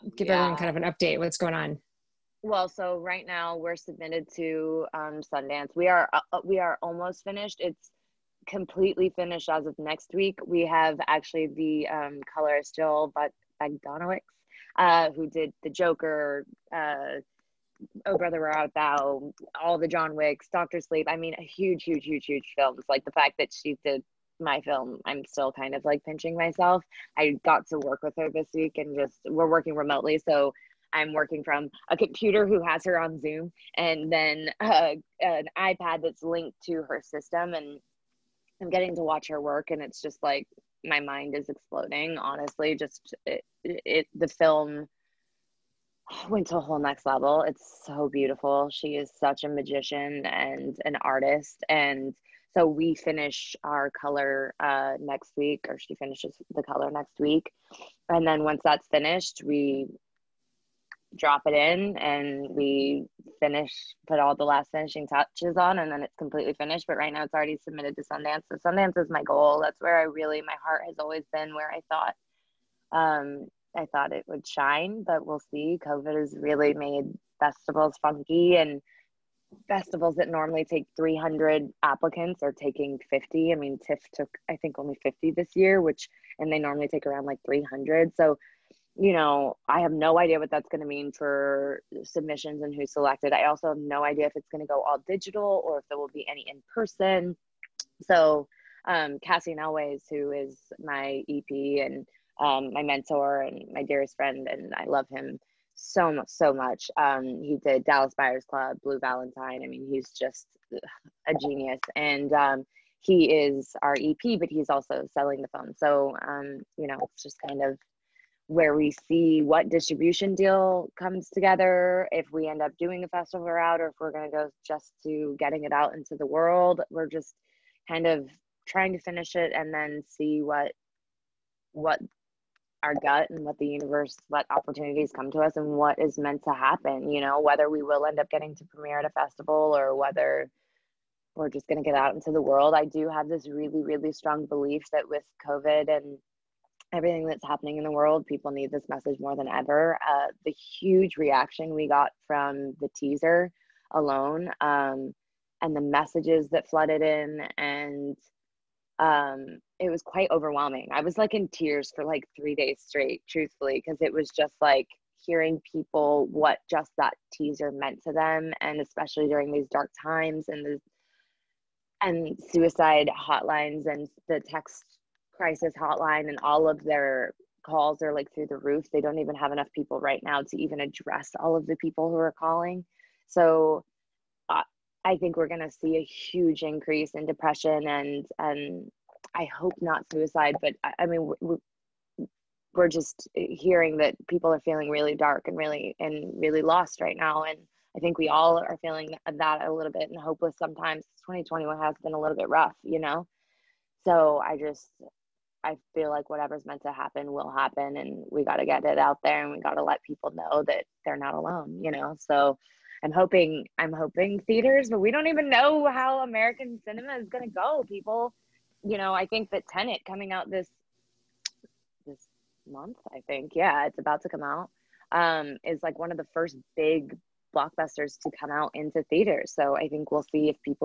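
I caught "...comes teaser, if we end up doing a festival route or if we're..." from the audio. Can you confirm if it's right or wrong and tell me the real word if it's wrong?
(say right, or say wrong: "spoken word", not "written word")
wrong: "together", not "teaser".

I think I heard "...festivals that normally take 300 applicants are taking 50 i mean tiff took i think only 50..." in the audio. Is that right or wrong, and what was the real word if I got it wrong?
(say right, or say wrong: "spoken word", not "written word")
right.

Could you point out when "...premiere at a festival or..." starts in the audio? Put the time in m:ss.
2:18.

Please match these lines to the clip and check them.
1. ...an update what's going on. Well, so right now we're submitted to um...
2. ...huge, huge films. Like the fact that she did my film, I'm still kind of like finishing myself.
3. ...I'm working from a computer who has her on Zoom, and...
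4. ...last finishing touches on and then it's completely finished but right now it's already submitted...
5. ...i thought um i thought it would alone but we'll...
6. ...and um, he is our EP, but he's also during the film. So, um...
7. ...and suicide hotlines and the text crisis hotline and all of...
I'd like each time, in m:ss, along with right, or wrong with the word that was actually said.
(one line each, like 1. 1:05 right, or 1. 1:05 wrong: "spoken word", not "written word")
1. 0:00 right
2. 0:22 wrong: "pinching", not "finishing"
3. 0:30 right
4. 1:04 right
5. 1:11 wrong: "shine", not "alone"
6. 1:51 wrong: "selling", not "during"
7. 2:52 right.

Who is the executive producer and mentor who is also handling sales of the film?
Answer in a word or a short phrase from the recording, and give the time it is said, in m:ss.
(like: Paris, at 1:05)
Cassian Elwes, at 1:39.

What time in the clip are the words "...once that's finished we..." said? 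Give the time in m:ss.
0:58.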